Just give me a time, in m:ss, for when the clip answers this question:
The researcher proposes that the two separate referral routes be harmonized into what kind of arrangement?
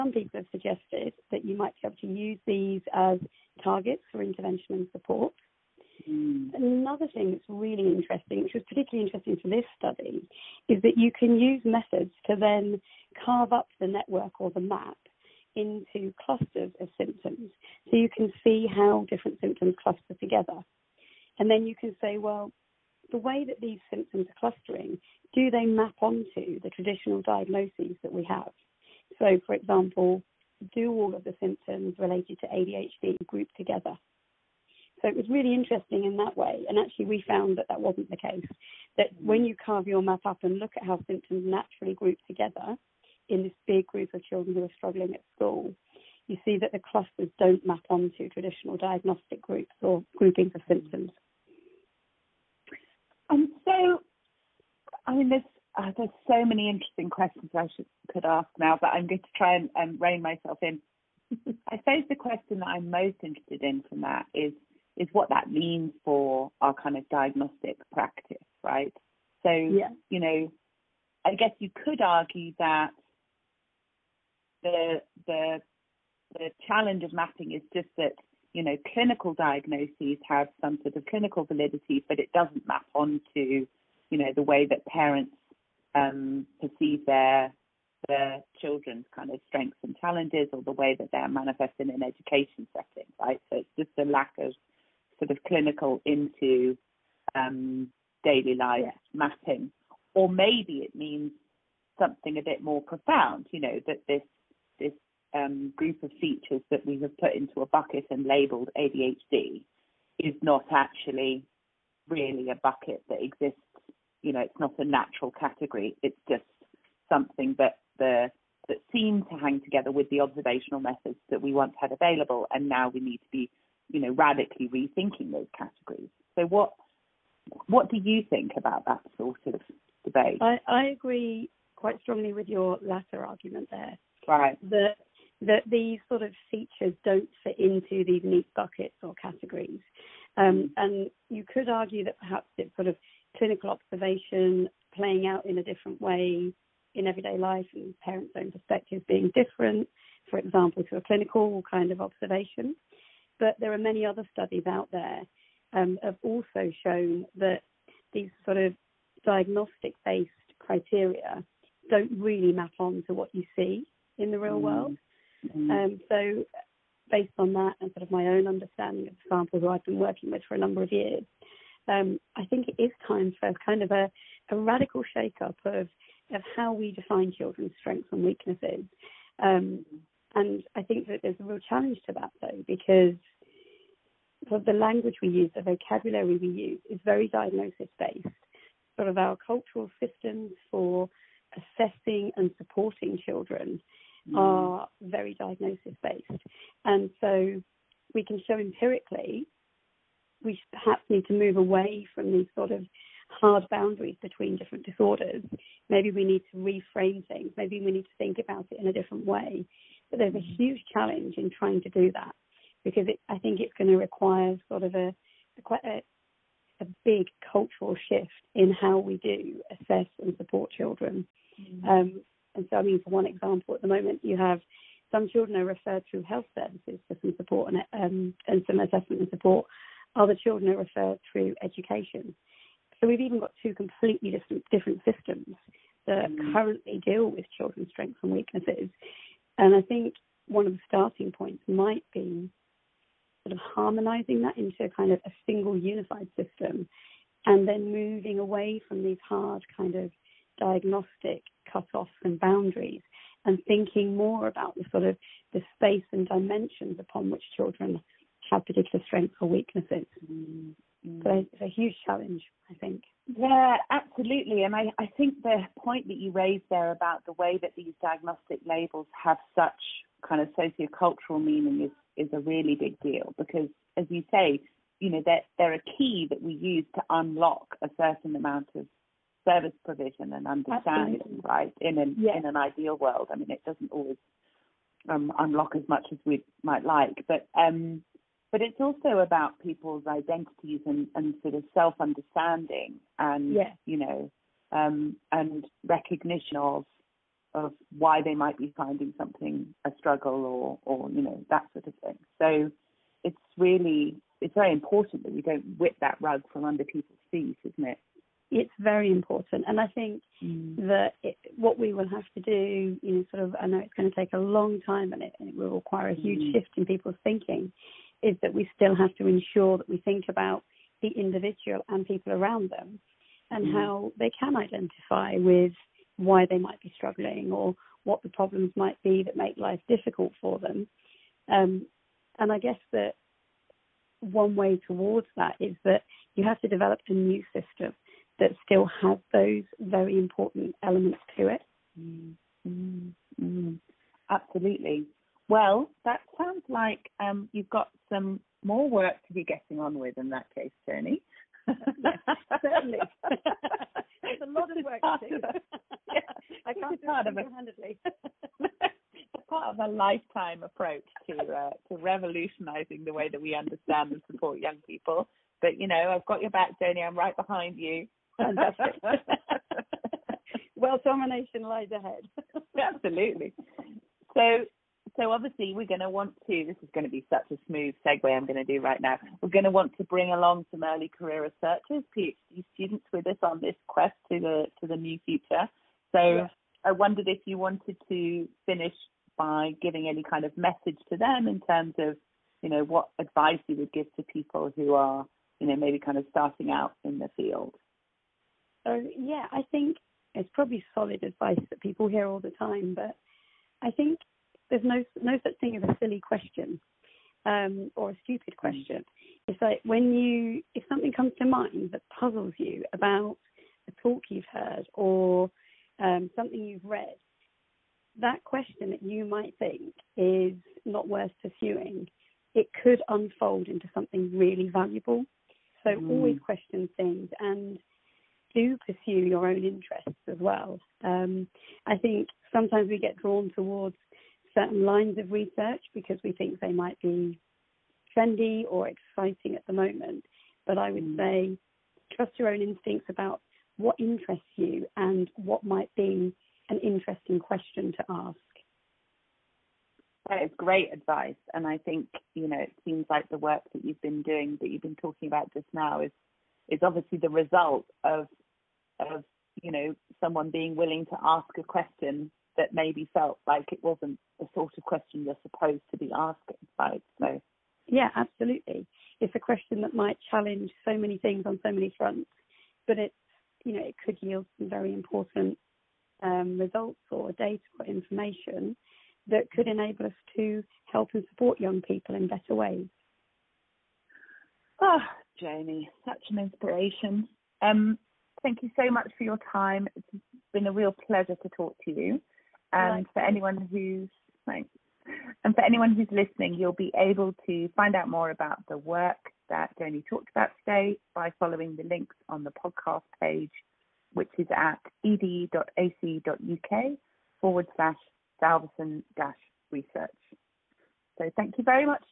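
4:05.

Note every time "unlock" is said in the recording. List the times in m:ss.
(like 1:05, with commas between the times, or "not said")
4:37, 4:45.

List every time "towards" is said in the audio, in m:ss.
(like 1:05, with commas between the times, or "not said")
5:34, 7:13.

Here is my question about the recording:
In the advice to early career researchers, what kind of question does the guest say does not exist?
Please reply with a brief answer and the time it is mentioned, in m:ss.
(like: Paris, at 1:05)
a silly question, at 6:45.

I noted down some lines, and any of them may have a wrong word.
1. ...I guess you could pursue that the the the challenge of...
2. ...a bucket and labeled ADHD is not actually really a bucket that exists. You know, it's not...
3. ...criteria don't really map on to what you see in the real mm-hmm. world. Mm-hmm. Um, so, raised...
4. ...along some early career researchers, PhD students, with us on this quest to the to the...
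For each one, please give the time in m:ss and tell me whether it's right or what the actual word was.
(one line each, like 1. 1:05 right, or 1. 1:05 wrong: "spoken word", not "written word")
1. 1:11 wrong: "argue", not "pursue"
2. 1:47 right
3. 2:40 wrong: "based", not "raised"
4. 6:20 right.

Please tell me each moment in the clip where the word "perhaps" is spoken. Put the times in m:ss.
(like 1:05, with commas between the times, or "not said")
2:22, 3:20.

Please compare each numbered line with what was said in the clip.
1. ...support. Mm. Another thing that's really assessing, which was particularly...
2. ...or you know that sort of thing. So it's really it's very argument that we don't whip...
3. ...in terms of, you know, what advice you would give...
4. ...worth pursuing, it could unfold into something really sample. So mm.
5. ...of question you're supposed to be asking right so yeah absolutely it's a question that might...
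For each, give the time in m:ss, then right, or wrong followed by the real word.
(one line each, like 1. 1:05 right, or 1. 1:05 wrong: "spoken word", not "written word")
1. 0:04 wrong: "interesting", not "assessing"
2. 5:00 wrong: "important", not "argument"
3. 6:31 right
4. 7:01 wrong: "valuable", not "sample"
5. 7:44 right.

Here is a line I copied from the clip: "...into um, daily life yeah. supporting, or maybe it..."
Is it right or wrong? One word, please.
wrong.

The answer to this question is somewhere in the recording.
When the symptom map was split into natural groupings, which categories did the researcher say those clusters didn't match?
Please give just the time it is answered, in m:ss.
0:48.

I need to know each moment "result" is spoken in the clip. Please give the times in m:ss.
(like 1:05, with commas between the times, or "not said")
7:37, 7:56.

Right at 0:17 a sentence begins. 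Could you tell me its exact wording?
So you can see how different symptoms cluster together.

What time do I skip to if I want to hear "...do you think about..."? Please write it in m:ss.
2:07.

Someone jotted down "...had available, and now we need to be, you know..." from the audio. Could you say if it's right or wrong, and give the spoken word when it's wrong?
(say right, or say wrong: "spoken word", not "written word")
right.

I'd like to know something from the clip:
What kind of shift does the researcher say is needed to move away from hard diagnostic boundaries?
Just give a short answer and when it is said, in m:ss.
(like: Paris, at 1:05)
a big cultural shift, at 3:37.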